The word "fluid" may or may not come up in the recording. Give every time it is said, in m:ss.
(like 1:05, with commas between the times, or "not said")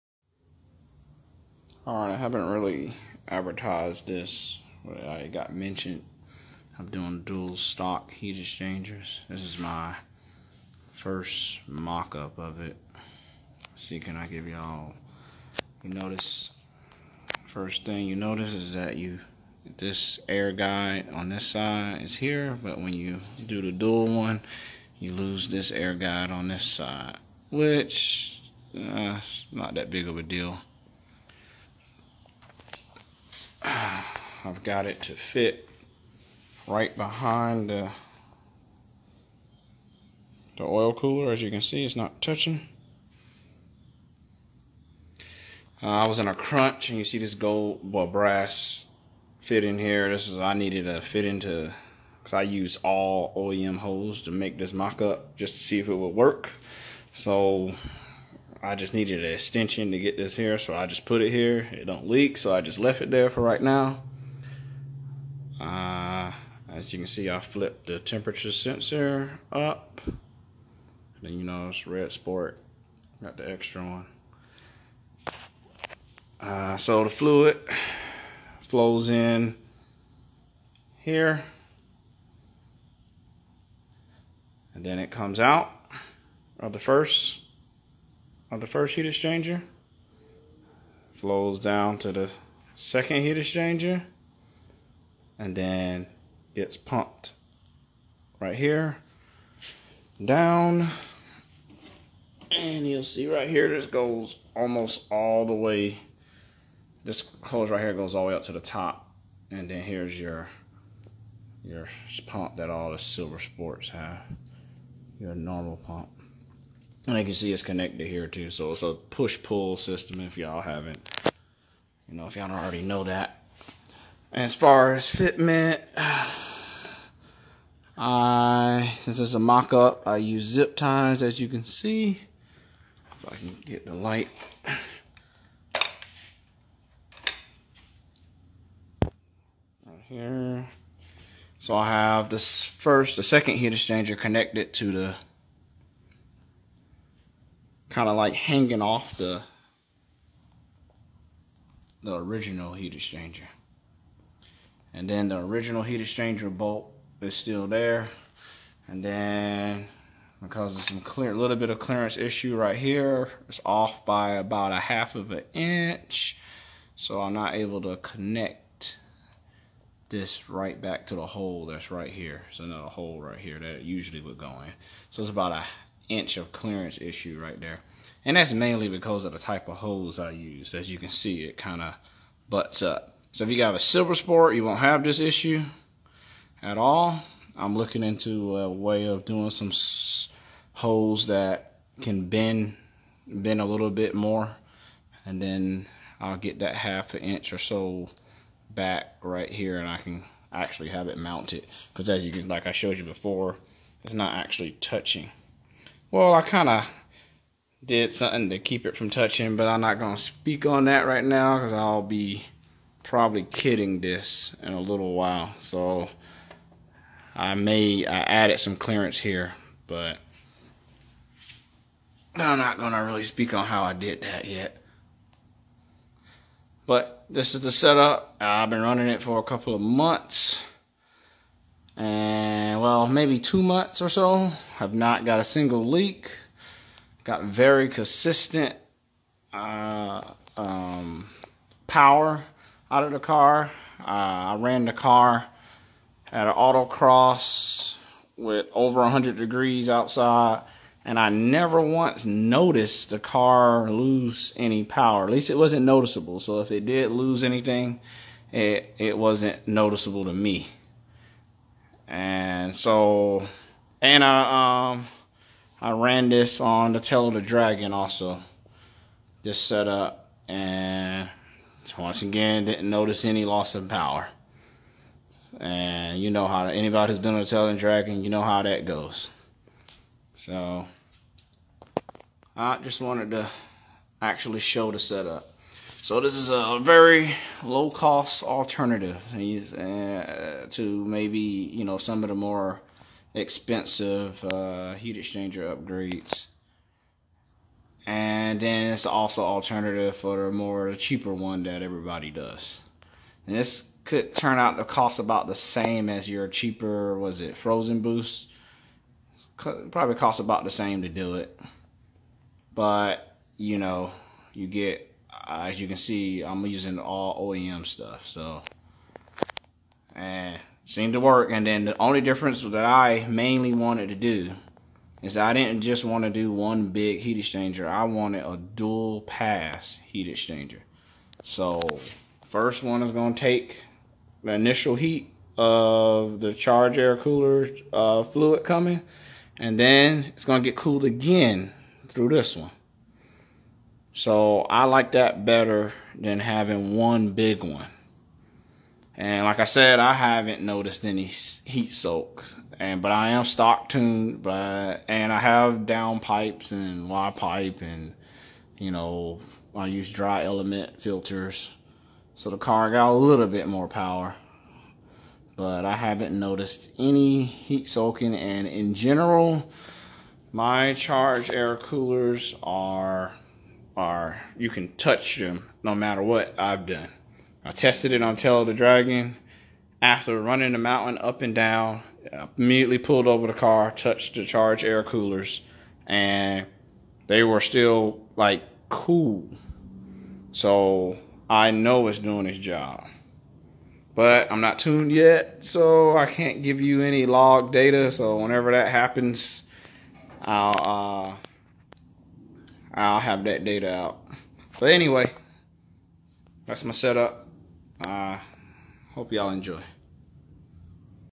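1:17, 5:38.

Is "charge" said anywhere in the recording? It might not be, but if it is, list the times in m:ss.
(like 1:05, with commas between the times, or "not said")
5:36, 6:10, 6:24.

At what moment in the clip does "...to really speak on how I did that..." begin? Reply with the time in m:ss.
3:42.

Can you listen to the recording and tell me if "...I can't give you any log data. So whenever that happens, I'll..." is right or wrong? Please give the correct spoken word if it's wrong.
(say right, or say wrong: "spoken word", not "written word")
right.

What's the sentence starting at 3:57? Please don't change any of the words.
Got very consistent uh, um, power out of the car.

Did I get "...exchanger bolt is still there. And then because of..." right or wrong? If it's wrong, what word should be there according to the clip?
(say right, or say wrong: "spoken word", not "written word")
right.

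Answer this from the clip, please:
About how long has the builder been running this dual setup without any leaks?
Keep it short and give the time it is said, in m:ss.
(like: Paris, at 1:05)
two months, at 3:53.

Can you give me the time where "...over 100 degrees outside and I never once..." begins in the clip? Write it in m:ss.
4:08.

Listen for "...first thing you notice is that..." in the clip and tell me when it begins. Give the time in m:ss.
0:17.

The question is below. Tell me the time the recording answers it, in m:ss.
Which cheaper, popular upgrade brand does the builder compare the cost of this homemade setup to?
5:07.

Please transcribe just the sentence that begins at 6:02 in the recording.
So the car got a little bit more power.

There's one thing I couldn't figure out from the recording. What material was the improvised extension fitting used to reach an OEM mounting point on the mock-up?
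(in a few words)
brass.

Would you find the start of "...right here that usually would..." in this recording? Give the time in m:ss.
2:53.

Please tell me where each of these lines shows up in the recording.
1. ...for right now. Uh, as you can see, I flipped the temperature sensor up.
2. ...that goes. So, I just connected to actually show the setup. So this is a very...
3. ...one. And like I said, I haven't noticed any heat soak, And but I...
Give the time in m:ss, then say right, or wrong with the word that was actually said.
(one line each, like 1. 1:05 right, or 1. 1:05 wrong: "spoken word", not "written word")
1. 1:03 right
2. 4:38 wrong: "wanted", not "connected"
3. 5:47 right.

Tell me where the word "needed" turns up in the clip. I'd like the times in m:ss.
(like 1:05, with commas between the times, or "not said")
0:50, 0:58.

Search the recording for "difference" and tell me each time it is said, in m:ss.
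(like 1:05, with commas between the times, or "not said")
5:22.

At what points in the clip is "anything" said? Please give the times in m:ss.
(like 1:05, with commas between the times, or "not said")
4:17.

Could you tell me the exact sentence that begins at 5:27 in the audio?
I wanted a dual pass heat exchanger.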